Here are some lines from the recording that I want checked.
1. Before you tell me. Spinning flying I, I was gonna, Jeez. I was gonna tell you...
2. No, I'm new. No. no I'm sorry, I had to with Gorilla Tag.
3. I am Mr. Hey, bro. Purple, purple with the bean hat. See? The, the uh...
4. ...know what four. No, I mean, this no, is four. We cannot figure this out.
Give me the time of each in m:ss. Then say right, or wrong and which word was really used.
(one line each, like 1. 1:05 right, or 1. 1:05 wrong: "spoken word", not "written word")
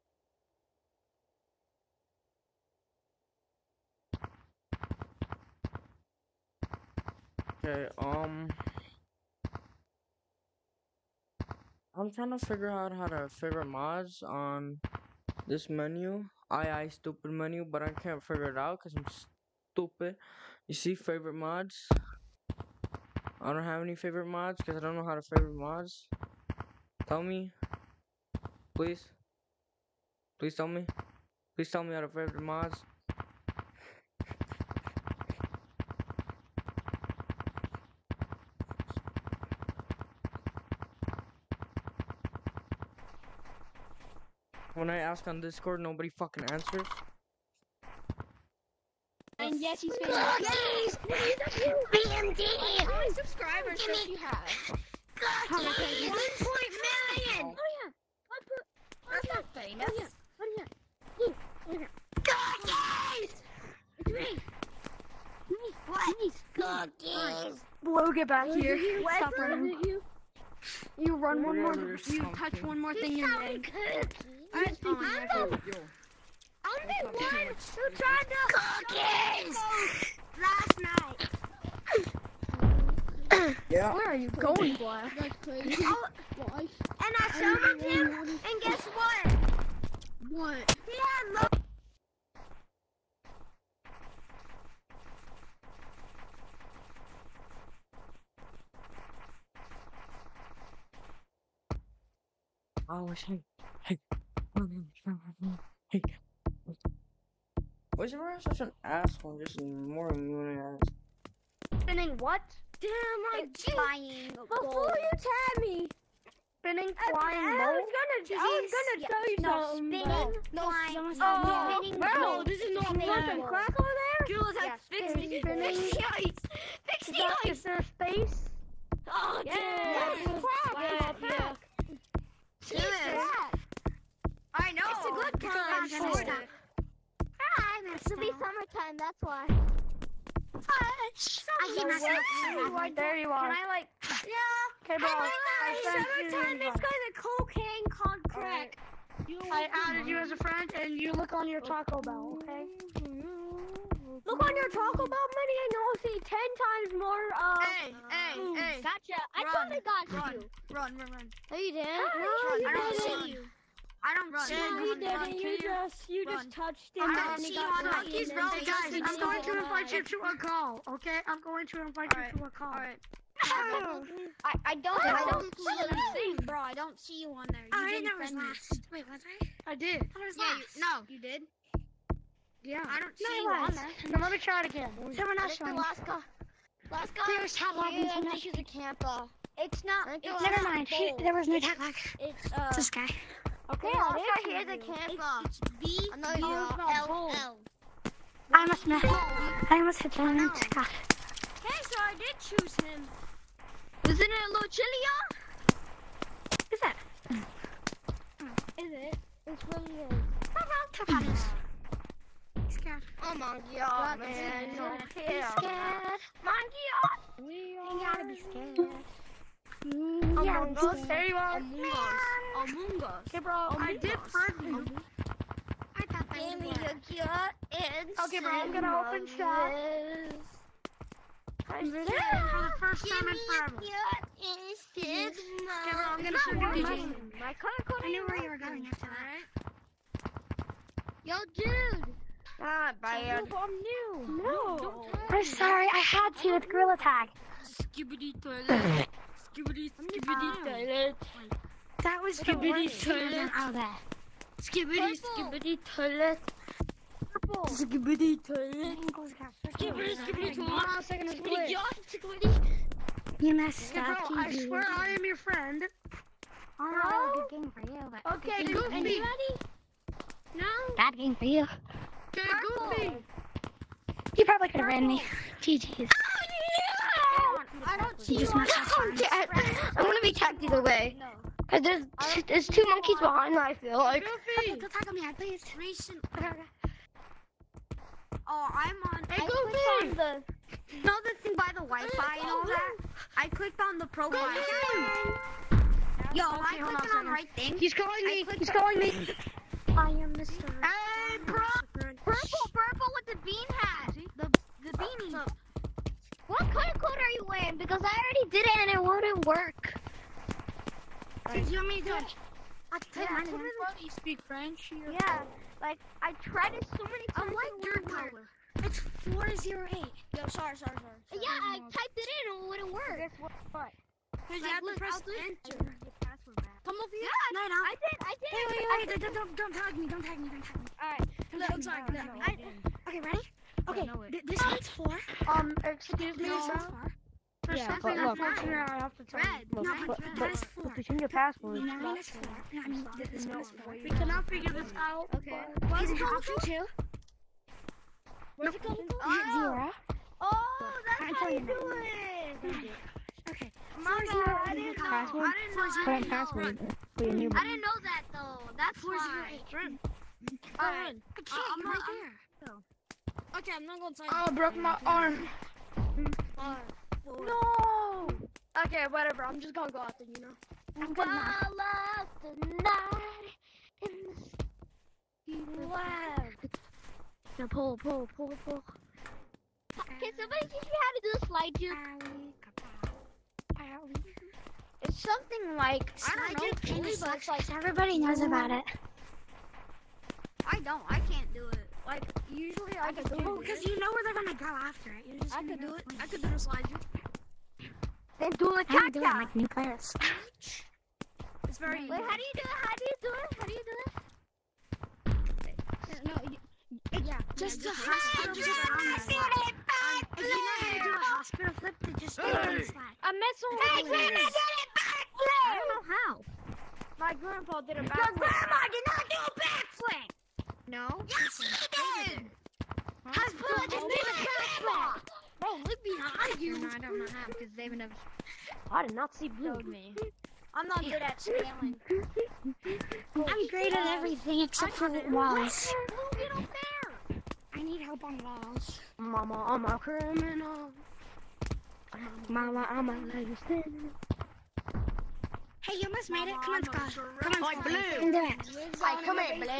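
1. 1:54 right
2. 4:03 right
3. 4:59 right
4. 5:41 right.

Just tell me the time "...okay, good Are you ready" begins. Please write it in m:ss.
4:28.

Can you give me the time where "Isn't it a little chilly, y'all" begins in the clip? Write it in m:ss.
3:24.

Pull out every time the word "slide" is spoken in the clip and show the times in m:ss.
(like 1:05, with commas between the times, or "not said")
6:21, 6:36, 6:52.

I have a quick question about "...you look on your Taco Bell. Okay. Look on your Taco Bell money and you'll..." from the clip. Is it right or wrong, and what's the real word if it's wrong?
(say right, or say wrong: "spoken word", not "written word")
right.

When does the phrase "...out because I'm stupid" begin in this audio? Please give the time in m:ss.
0:18.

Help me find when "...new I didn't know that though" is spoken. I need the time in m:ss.
5:57.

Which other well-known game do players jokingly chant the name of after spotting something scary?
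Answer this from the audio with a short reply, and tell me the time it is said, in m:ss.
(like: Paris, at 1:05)
Among Us, at 3:42.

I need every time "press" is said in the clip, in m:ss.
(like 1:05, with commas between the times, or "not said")
5:25.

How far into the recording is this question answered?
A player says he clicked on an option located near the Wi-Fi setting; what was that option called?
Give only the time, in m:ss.
4:54.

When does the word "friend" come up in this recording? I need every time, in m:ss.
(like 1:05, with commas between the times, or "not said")
2:30, 4:25.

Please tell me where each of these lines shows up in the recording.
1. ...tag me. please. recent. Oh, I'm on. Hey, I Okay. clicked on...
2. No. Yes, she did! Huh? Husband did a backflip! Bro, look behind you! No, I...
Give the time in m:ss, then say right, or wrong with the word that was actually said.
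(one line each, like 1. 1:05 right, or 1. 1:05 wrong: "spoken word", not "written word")
1. 4:44 wrong: "Goofy", not "Okay"
2. 7:00 right.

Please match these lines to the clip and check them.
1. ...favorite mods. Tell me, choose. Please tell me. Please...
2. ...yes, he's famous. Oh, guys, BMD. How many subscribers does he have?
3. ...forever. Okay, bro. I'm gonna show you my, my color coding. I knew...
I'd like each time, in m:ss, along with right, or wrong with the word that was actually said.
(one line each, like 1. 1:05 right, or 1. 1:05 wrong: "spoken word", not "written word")
1. 0:25 wrong: "please", not "choose"
2. 0:49 right
3. 3:53 right.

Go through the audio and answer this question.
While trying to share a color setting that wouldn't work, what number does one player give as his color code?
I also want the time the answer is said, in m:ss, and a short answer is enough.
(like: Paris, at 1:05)
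408, at 5:19.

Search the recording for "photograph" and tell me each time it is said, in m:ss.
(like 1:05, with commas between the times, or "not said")
not said.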